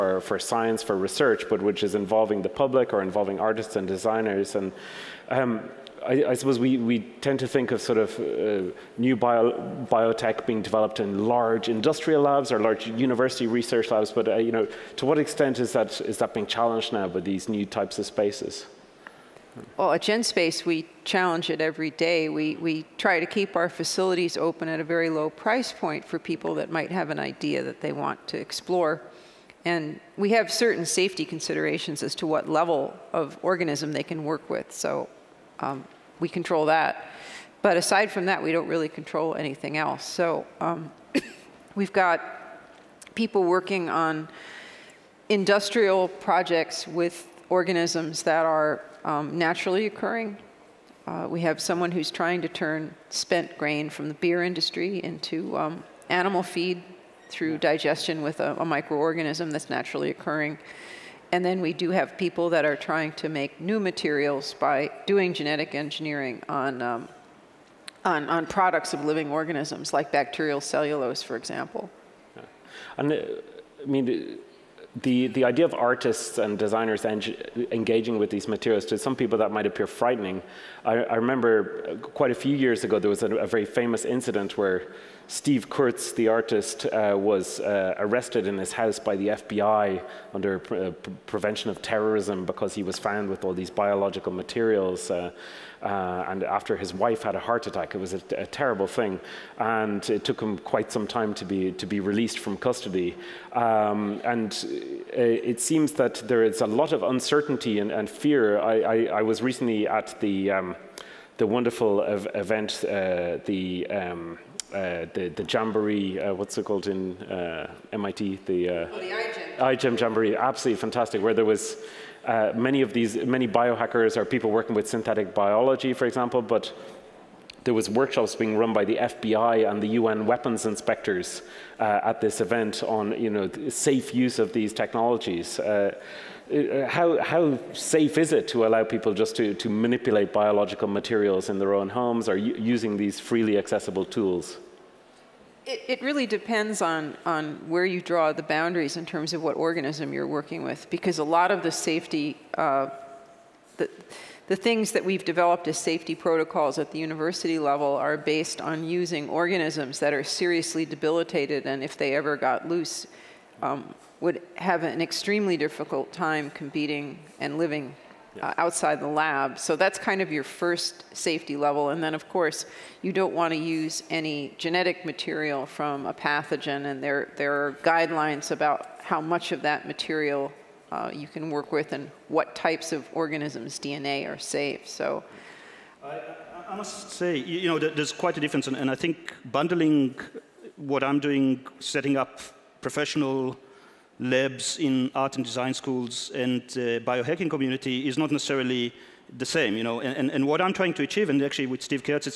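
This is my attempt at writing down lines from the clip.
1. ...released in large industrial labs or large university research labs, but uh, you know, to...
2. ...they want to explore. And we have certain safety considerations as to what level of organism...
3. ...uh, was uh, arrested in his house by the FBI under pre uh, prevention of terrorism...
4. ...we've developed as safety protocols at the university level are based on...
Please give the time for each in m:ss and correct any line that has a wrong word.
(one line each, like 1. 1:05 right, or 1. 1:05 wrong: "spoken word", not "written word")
1. 0:10 wrong: "developed", not "released"
2. 0:27 right
3. 1:26 right
4. 2:35 right.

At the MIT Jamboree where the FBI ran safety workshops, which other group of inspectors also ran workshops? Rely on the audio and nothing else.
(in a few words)
UN weapons inspectors.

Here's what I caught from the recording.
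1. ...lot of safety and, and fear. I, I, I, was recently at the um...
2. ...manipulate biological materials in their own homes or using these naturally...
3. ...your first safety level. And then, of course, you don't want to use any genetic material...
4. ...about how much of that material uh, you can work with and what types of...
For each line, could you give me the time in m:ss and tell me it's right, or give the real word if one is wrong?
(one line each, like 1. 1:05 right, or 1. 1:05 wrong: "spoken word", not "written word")
1. 1:46 wrong: "uncertainty", not "safety"
2. 2:19 wrong: "freely", not "naturally"
3. 2:50 right
4. 2:58 right.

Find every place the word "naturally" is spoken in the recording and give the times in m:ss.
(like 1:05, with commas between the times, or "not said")
0:49, 0:59.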